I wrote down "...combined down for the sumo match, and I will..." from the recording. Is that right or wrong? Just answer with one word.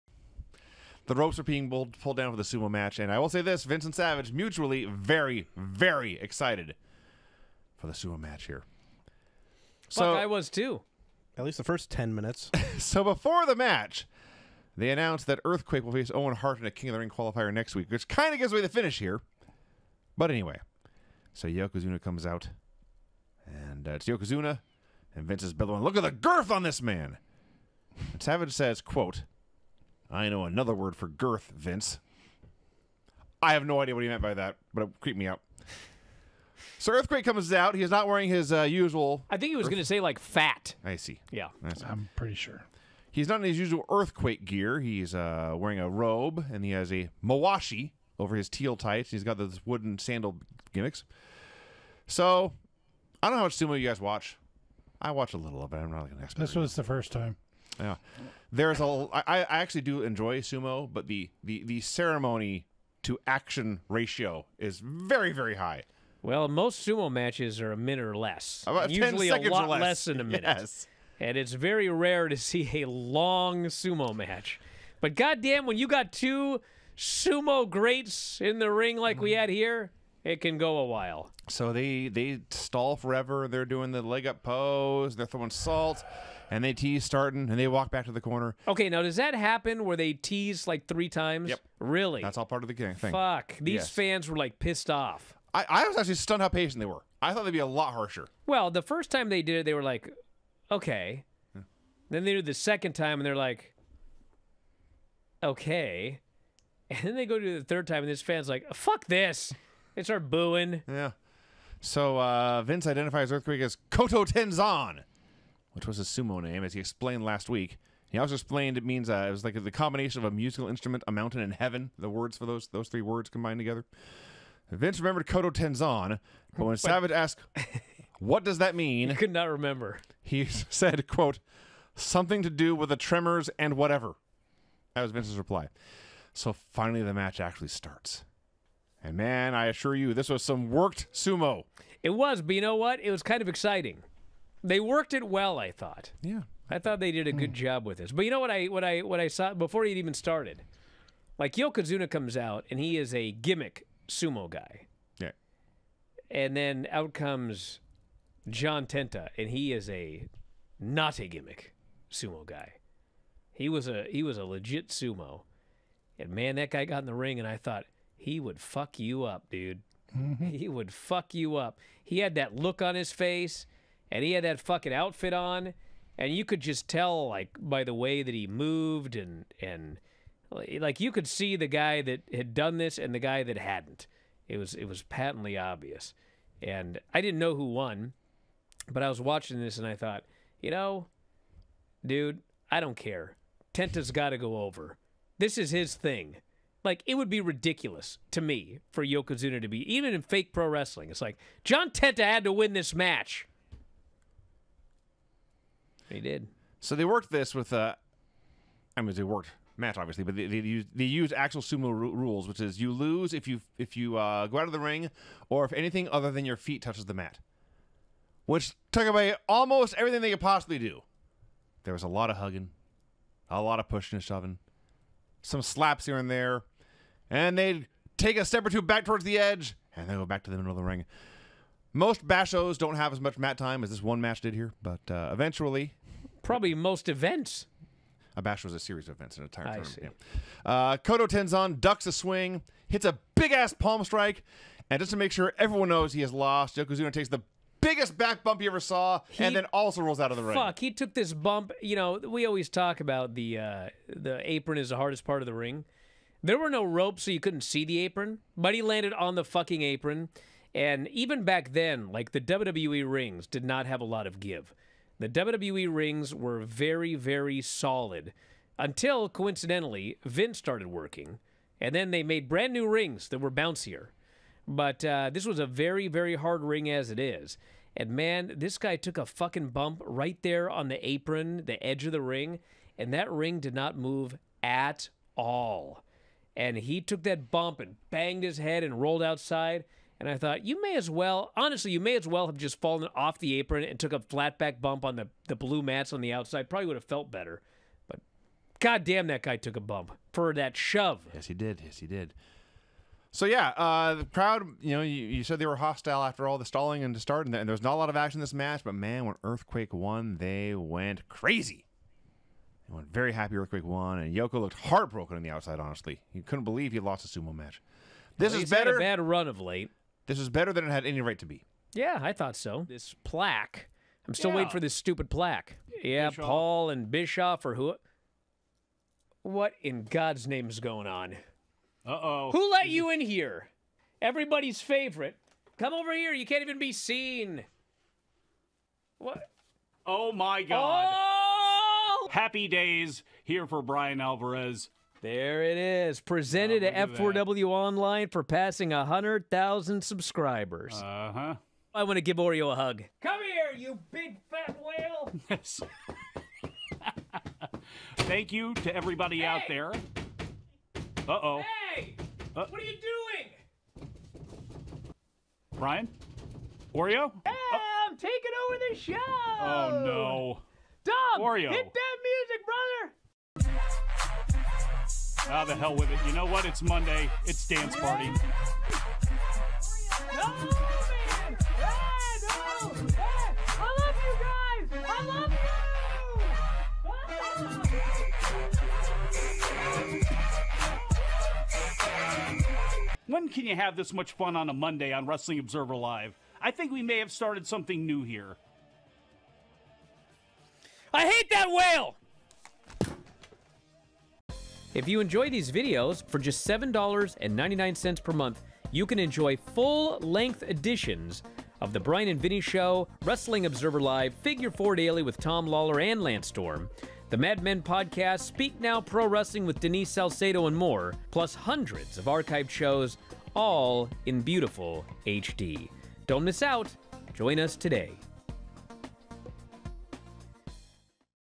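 wrong.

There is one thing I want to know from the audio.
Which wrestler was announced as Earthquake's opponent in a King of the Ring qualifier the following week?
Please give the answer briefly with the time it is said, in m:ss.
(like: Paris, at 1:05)
Owen Hart, at 0:16.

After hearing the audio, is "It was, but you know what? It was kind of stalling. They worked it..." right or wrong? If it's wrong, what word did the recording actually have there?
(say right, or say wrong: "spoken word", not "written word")
wrong: "exciting", not "stalling".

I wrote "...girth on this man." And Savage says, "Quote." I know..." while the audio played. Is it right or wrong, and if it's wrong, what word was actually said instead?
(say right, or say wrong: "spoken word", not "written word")
right.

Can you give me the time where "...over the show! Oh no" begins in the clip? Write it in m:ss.
6:08.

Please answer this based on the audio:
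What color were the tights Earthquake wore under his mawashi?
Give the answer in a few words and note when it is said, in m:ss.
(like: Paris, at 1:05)
teal, at 0:48.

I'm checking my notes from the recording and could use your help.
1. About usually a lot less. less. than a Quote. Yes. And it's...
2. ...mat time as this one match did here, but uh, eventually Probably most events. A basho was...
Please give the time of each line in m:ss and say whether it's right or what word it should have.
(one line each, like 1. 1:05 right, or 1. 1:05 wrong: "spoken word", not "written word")
1. 1:08 wrong: "minute", not "Quote"
2. 3:53 right.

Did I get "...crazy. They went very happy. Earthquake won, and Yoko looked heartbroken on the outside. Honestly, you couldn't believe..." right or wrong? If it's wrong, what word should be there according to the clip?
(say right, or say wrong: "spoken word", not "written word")
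right.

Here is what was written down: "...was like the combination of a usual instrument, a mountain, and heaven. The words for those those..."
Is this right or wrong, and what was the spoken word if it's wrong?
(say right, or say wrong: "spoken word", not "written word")
wrong: "musical", not "usual".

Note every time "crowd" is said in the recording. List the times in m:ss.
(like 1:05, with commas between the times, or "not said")
5:04.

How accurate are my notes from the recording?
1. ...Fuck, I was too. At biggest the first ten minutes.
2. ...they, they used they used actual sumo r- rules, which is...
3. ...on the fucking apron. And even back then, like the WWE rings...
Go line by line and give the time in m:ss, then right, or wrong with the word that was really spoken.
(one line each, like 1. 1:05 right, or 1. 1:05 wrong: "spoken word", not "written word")
1. 0:10 wrong: "least", not "biggest"
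2. 3:30 right
3. 4:19 right.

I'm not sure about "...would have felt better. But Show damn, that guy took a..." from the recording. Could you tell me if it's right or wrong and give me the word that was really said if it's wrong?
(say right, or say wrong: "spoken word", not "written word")
wrong: "God", not "Show".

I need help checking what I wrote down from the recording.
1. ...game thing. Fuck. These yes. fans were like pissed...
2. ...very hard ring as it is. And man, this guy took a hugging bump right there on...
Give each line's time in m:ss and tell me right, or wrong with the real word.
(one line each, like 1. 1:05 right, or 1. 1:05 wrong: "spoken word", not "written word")
1. 1:32 right
2. 4:36 wrong: "fucking", not "hugging".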